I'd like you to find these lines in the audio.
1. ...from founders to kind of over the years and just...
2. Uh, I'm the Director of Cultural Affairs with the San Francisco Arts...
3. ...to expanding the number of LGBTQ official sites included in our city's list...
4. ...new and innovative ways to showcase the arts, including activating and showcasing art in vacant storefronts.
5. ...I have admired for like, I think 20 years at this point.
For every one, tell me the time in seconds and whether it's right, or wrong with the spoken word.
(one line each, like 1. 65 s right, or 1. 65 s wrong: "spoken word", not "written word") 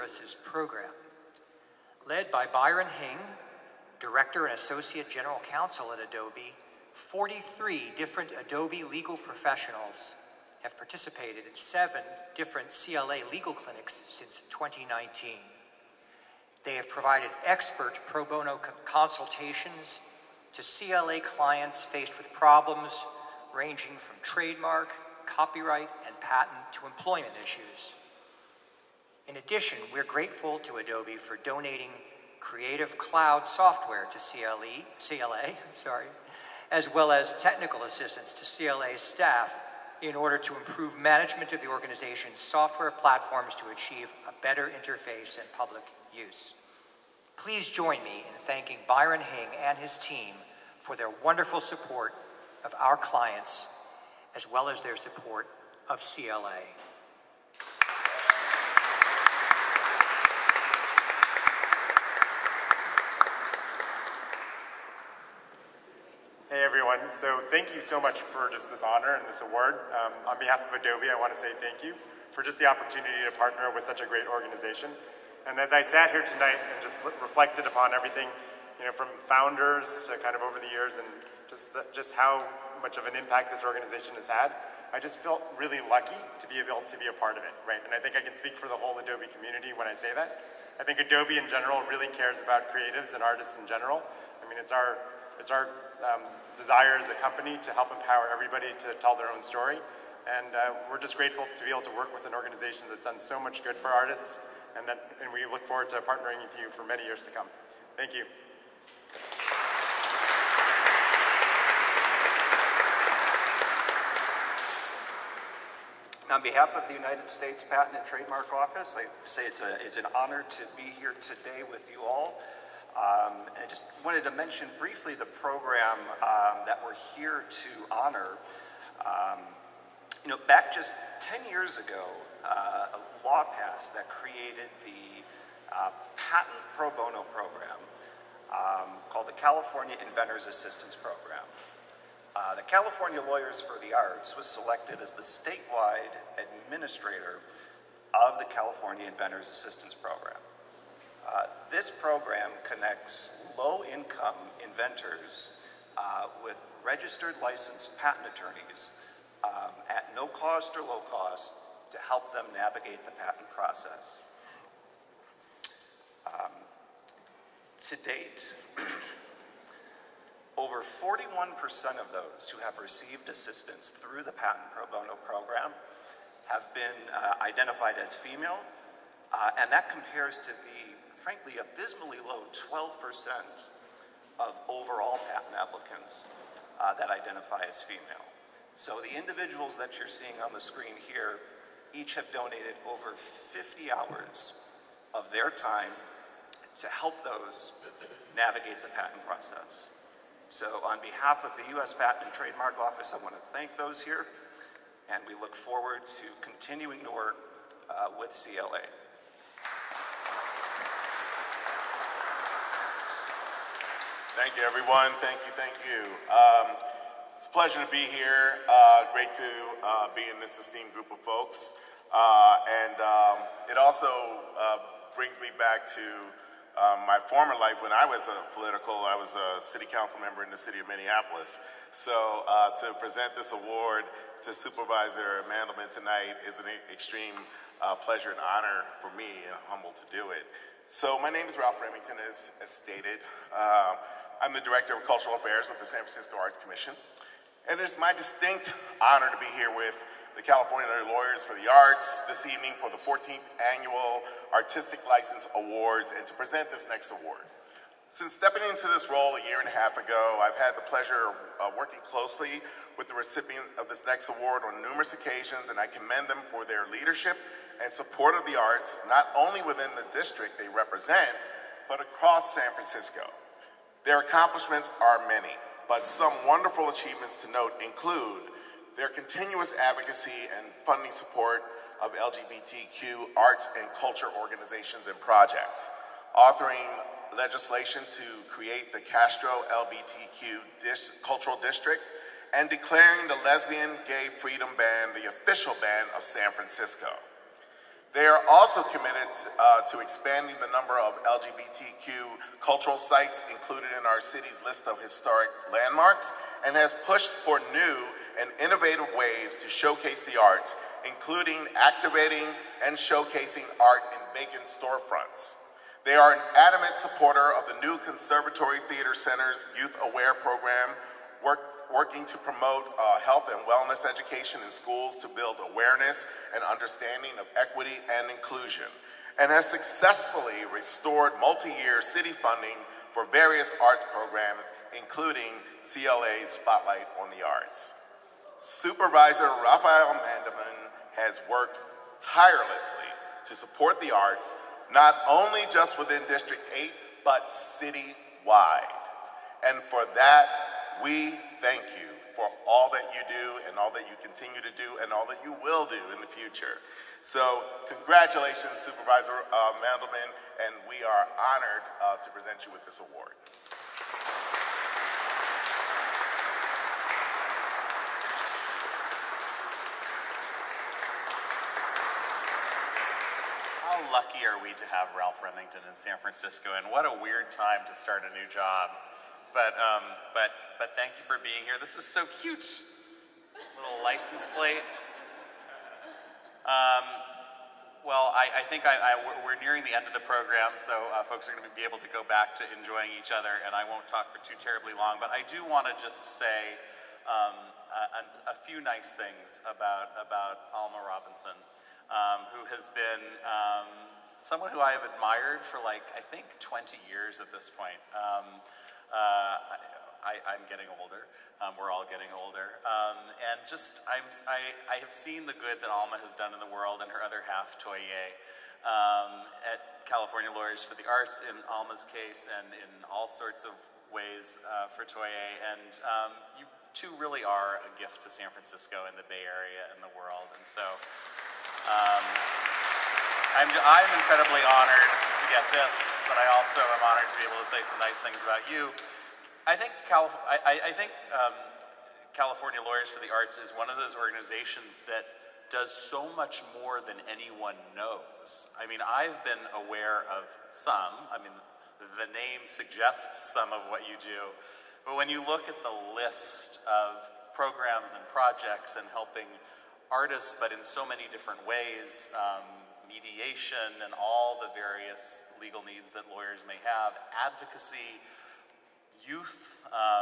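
1. 78 s right
2. 243 s right
3. 299 s wrong: "cultural", not "official"
4. 307 s right
5. 404 s right.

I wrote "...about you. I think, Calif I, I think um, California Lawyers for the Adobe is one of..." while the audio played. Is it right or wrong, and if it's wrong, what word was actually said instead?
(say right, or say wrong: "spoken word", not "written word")
wrong: "Arts", not "Adobe".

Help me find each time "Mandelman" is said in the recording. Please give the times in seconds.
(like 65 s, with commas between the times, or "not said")
235 s, 340 s, 359 s.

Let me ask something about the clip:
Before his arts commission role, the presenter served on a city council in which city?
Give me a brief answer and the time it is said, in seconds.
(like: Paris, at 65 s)
Minneapolis, at 230 s.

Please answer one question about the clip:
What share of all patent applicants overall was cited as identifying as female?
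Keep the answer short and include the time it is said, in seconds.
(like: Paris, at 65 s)
12%, at 182 s.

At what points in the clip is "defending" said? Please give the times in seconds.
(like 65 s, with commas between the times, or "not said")
not said.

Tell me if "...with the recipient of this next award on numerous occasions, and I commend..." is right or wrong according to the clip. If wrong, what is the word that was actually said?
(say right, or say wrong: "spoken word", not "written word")
right.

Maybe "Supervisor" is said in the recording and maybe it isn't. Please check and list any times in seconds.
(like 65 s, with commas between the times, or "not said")
234 s, 338 s, 358 s.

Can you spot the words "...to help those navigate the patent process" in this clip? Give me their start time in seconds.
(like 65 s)
196 s.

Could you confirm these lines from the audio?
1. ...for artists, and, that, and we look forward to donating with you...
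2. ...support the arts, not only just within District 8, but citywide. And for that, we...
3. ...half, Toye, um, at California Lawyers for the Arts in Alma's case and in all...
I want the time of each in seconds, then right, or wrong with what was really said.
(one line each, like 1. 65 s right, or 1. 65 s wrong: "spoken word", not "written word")
1. 103 s wrong: "partnering", not "donating"
2. 343 s right
3. 417 s right.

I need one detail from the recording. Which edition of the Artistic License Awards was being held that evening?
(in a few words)
14th.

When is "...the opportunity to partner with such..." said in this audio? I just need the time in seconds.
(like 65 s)
72 s.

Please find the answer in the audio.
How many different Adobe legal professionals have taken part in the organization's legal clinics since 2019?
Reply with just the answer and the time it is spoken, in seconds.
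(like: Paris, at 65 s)
43, at 6 s.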